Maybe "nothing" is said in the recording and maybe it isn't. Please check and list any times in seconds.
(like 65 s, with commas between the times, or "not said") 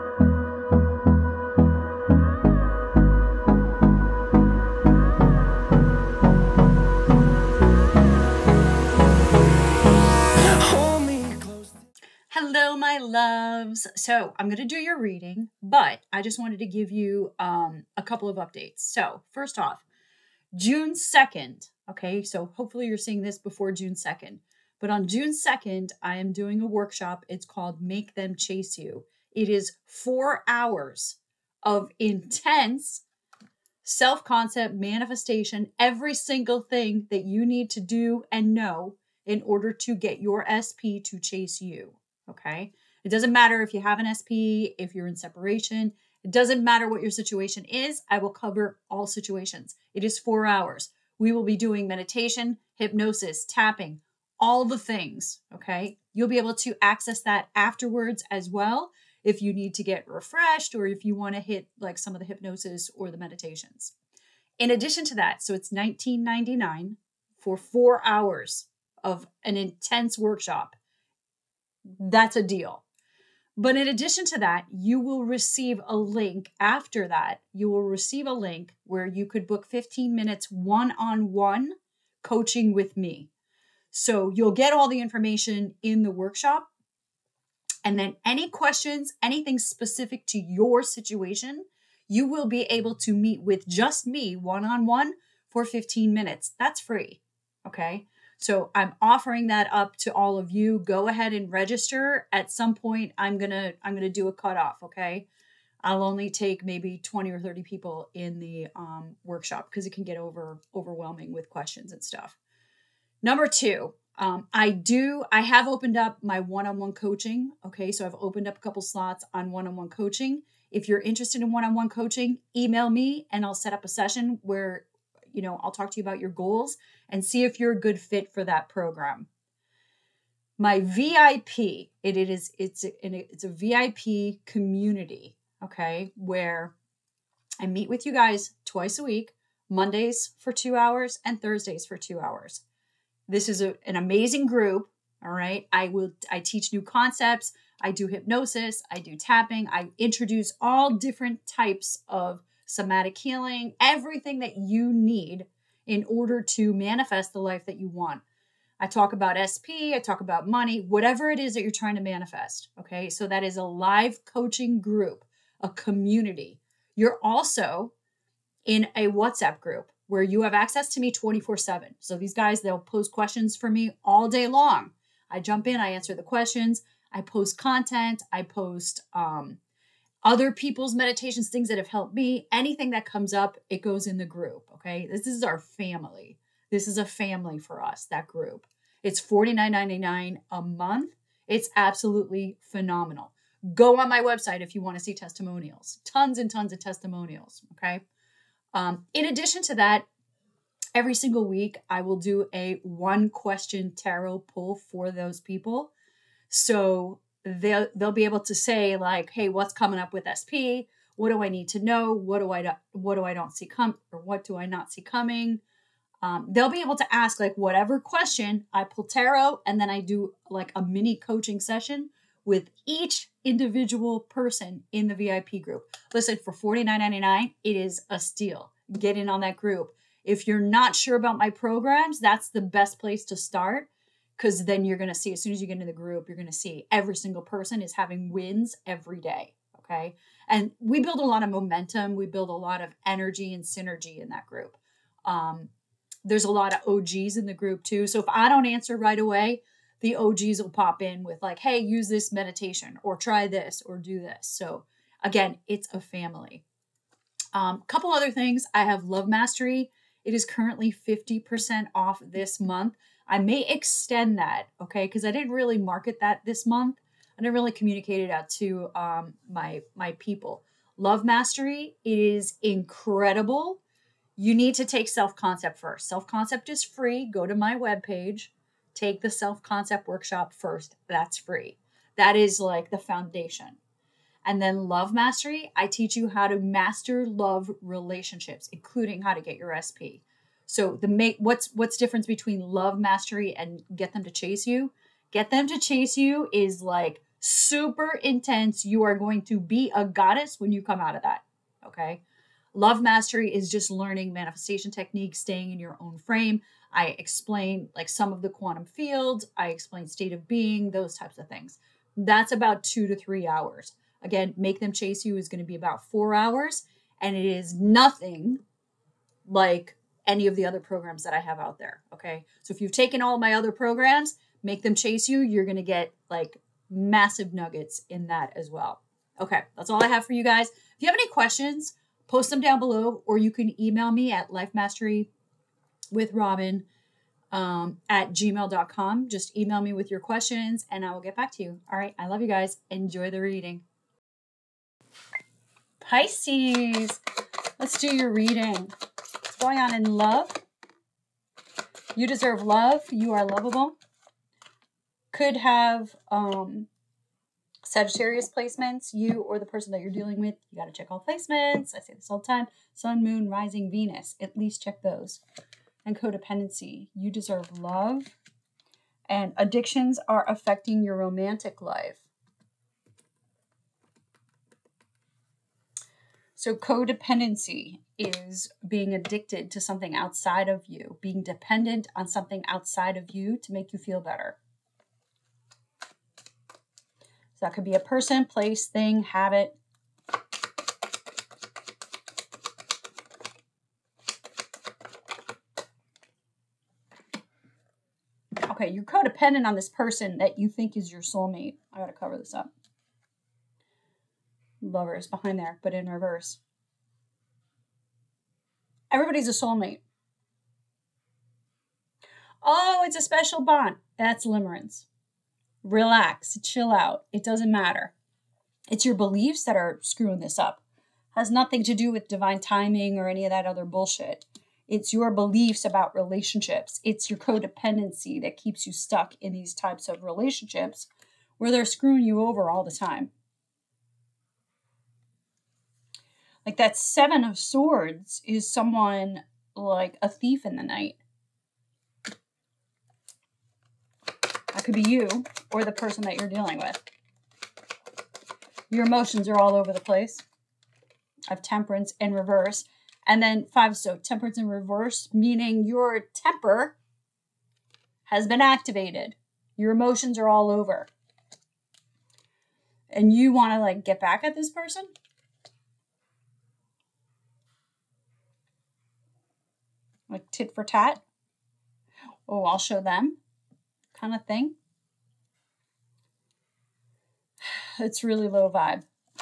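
317 s, 421 s.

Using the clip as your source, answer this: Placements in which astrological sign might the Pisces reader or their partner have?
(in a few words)
Sagittarius.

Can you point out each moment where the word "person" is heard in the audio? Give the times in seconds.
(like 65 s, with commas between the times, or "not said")
224 s, 237 s, 359 s, 387 s, 399 s, 445 s, 464 s.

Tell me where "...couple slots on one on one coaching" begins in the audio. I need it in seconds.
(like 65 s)
118 s.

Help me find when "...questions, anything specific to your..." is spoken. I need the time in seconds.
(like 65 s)
88 s.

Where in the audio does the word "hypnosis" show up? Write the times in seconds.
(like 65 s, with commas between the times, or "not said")
52 s, 62 s, 148 s.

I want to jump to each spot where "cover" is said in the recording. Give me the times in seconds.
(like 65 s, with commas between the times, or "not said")
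48 s, 402 s.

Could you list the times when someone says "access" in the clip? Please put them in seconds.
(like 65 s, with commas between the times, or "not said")
56 s, 170 s.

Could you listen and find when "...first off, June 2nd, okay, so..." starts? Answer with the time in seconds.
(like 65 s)
19 s.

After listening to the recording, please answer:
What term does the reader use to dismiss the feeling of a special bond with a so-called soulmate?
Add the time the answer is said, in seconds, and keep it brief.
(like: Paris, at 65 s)
limerence, at 414 s.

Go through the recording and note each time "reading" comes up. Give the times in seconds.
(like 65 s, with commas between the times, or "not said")
14 s, 343 s, 348 s.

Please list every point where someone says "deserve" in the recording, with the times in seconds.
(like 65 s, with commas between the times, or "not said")
352 s, 367 s.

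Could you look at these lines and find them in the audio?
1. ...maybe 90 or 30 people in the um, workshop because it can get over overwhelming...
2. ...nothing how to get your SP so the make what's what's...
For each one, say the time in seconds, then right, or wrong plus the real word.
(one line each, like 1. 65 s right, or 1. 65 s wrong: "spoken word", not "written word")
1. 106 s wrong: "20", not "90"
2. 288 s wrong: "including", not "nothing".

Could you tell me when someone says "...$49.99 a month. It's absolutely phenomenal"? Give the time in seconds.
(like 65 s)
189 s.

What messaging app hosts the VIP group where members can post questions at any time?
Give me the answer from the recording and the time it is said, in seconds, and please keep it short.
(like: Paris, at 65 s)
WhatsApp, at 169 s.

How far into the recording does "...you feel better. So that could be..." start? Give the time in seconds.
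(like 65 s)
383 s.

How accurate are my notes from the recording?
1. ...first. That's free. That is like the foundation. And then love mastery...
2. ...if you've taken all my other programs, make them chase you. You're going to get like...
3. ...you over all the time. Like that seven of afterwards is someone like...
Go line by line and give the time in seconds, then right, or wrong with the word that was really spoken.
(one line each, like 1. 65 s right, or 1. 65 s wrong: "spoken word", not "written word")
1. 280 s right
2. 322 s right
3. 432 s wrong: "swords", not "afterwards".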